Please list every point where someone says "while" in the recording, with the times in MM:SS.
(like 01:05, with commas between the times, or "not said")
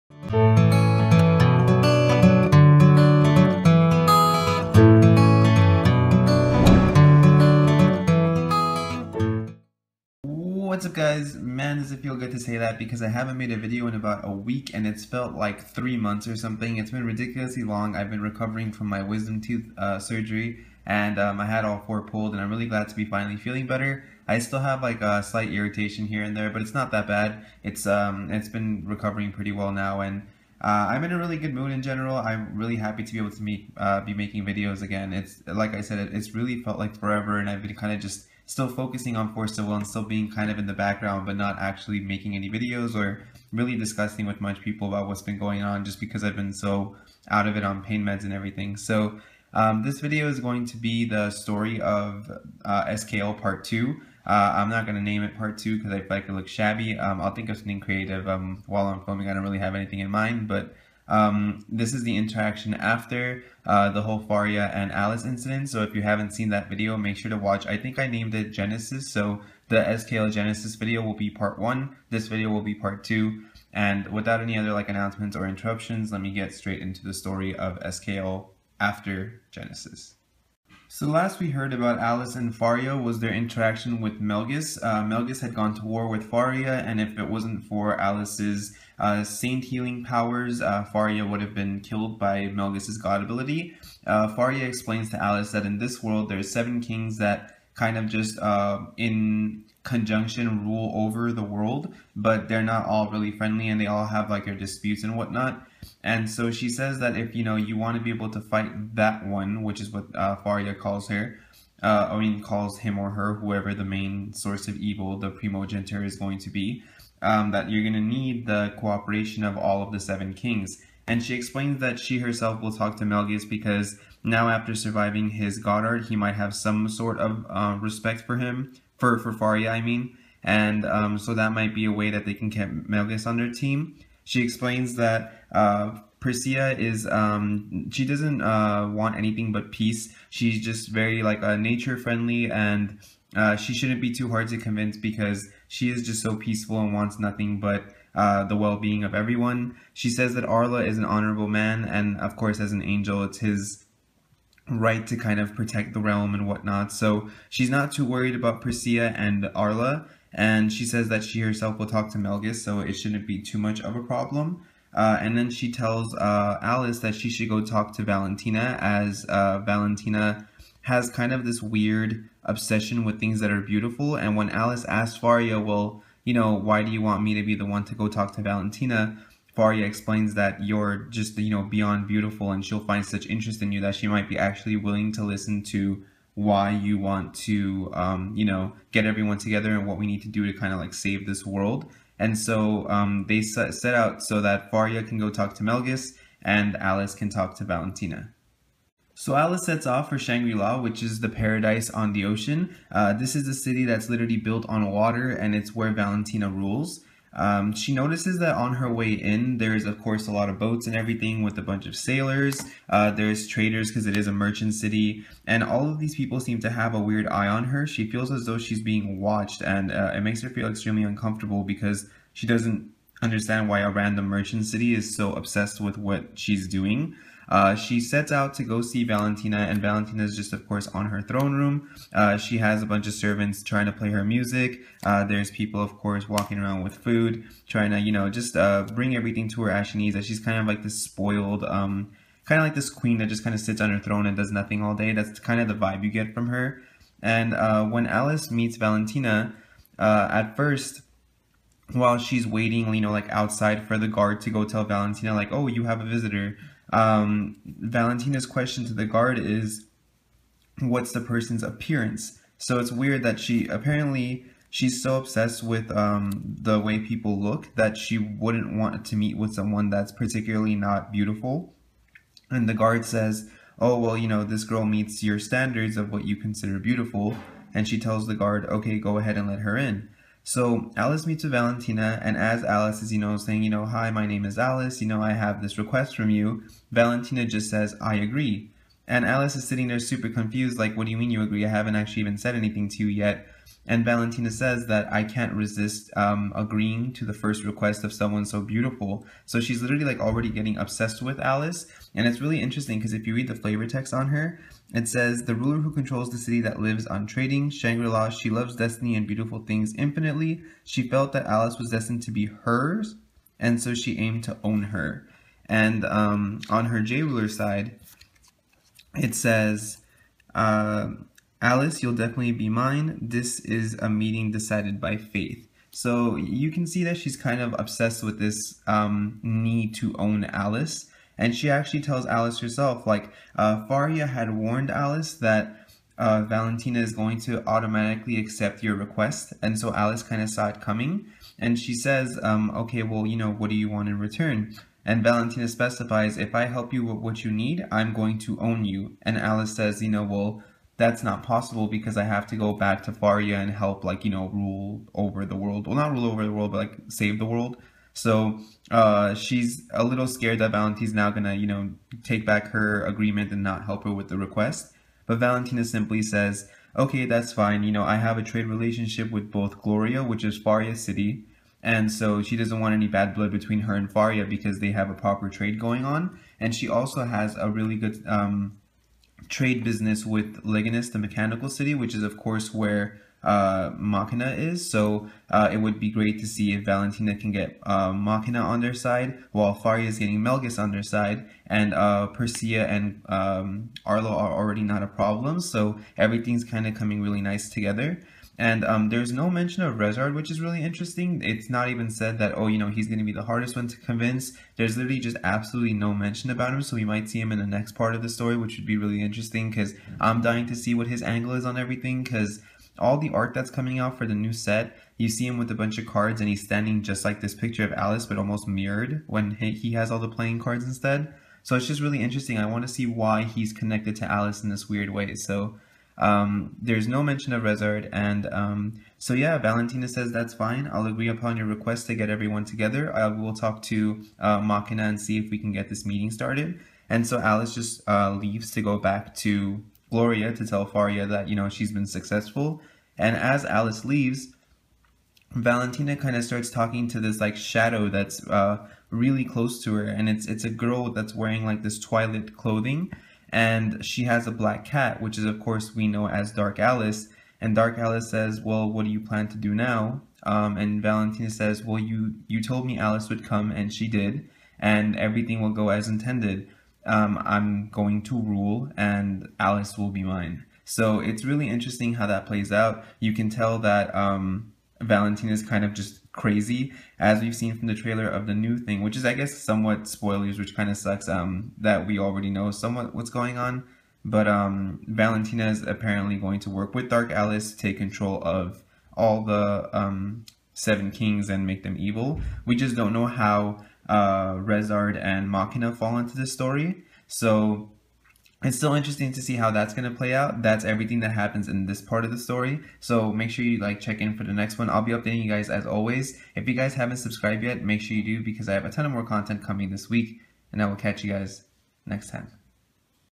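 00:58, 04:11, 06:29.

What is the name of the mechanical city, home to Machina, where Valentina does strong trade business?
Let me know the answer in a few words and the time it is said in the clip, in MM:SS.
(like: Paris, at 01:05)
Leganes, at 06:20.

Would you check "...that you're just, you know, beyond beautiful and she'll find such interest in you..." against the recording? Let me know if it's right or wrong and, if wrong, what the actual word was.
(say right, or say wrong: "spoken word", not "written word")
right.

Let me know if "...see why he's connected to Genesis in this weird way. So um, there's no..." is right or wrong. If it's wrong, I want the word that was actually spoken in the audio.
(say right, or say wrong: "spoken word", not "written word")
wrong: "Alice", not "Genesis".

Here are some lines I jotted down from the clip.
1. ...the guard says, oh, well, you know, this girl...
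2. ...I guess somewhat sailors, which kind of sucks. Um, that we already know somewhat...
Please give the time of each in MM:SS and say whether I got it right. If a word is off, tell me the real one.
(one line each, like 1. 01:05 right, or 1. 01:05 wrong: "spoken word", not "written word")
1. 04:32 right
2. 07:59 wrong: "spoilers", not "sailors".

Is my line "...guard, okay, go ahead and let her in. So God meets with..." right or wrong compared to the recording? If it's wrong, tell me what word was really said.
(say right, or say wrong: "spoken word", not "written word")
wrong: "Alice", not "God".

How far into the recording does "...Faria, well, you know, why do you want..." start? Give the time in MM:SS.
02:55.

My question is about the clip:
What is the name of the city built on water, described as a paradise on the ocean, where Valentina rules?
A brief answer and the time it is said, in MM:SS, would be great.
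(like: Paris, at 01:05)
Shangri-La, at 03:20.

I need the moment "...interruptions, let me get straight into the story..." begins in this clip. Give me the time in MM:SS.
01:15.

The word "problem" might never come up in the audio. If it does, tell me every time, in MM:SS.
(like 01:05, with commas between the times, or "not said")
02:44, 06:35.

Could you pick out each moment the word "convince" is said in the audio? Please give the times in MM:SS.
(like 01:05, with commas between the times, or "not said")
02:24, 06:43.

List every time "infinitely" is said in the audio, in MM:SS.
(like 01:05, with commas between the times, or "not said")
05:09.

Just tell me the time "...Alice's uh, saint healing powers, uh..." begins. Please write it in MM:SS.
01:27.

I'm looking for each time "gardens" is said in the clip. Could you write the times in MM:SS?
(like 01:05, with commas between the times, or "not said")
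not said.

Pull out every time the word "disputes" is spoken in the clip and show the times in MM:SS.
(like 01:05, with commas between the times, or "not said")
01:44.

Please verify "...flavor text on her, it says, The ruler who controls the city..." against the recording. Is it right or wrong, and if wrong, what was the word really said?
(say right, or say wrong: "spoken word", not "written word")
right.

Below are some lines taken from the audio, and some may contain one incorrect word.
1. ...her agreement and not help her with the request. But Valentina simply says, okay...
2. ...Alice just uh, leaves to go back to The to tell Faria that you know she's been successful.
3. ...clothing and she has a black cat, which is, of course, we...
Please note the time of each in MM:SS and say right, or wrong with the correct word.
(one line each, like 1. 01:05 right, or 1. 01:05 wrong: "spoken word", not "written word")
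1. 06:02 right
2. 07:17 wrong: "Gloria", not "The"
3. 07:32 right.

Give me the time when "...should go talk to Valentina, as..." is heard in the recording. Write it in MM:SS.
02:47.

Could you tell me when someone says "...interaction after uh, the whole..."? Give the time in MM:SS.
01:02.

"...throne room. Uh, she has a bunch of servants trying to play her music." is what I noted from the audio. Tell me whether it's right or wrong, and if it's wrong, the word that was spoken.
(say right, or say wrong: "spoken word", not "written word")
right.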